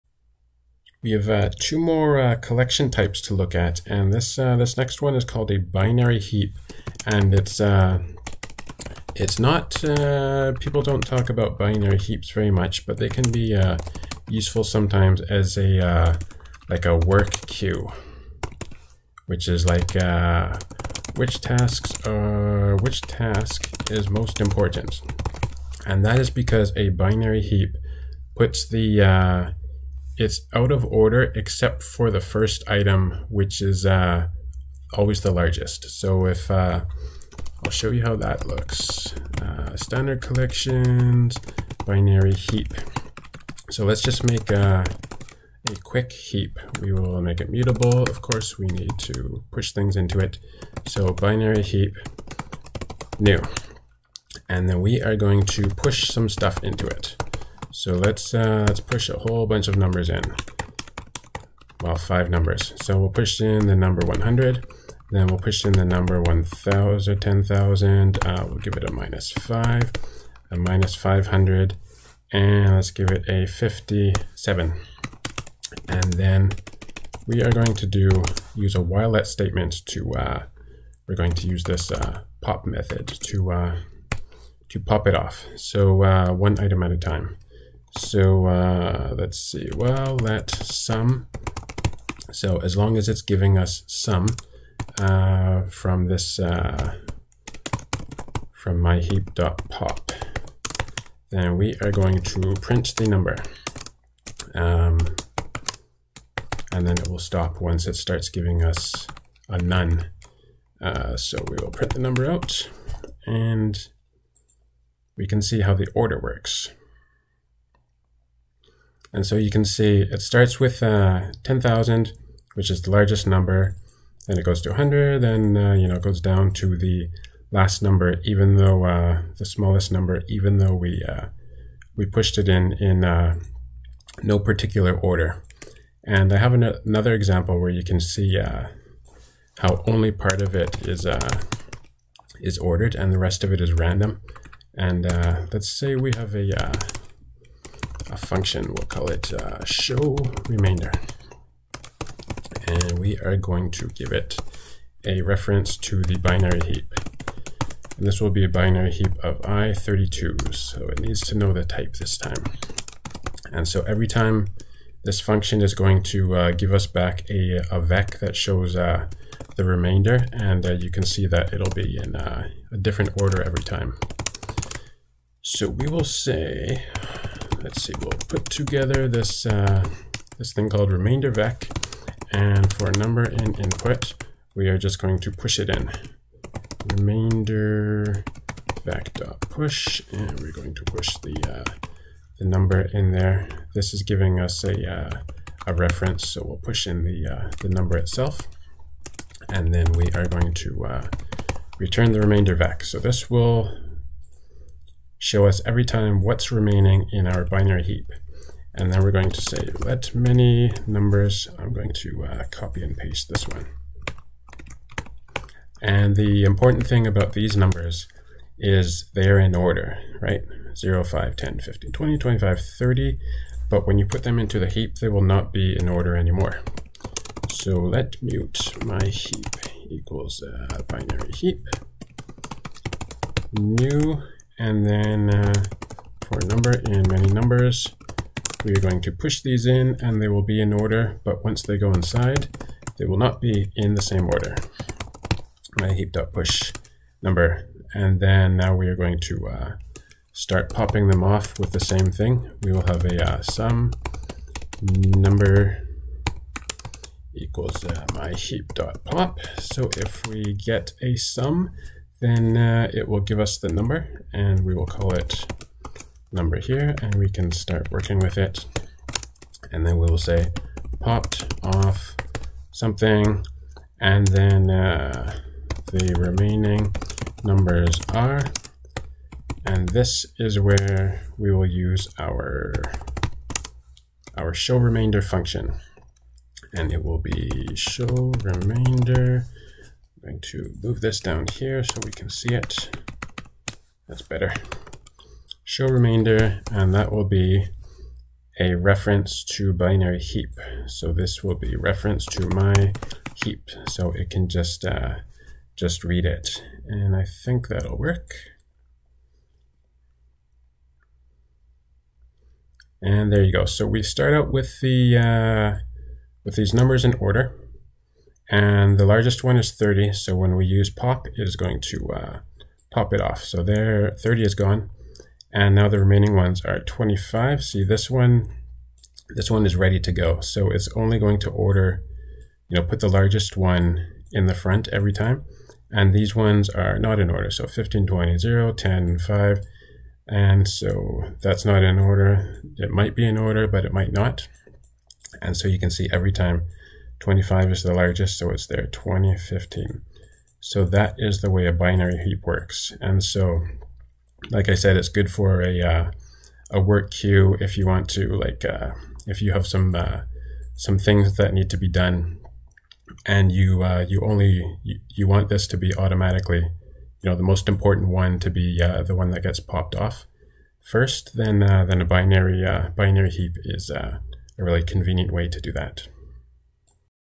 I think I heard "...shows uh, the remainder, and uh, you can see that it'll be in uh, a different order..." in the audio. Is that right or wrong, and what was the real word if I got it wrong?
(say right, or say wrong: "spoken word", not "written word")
right.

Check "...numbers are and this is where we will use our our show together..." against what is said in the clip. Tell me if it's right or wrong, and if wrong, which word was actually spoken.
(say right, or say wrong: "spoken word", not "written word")
wrong: "remainder", not "together".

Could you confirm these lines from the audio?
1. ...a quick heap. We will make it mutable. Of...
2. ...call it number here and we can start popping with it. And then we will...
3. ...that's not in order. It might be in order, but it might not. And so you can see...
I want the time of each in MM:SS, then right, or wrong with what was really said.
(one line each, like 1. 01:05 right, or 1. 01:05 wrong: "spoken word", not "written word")
1. 00:45 right
2. 04:24 wrong: "working", not "popping"
3. 05:41 right.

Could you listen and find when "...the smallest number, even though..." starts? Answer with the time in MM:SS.
02:09.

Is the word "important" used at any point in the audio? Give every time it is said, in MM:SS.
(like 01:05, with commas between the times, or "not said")
00:24, 03:36, 06:07.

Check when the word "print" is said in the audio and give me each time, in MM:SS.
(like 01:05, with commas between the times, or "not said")
01:42, 01:51.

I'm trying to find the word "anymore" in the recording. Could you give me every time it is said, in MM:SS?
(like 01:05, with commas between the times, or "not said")
03:46.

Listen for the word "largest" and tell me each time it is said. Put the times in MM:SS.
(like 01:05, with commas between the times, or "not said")
00:35, 02:02, 05:19, 05:33, 05:47.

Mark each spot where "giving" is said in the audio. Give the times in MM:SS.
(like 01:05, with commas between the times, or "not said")
01:33, 01:48, 03:14.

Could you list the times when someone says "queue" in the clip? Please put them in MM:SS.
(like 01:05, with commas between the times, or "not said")
00:17, 05:57.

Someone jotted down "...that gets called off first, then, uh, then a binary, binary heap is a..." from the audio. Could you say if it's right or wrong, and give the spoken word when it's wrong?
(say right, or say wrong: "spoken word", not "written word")
wrong: "popped", not "called".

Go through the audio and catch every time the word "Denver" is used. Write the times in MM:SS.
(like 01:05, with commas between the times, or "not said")
not said.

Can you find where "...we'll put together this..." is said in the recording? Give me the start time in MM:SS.
02:57.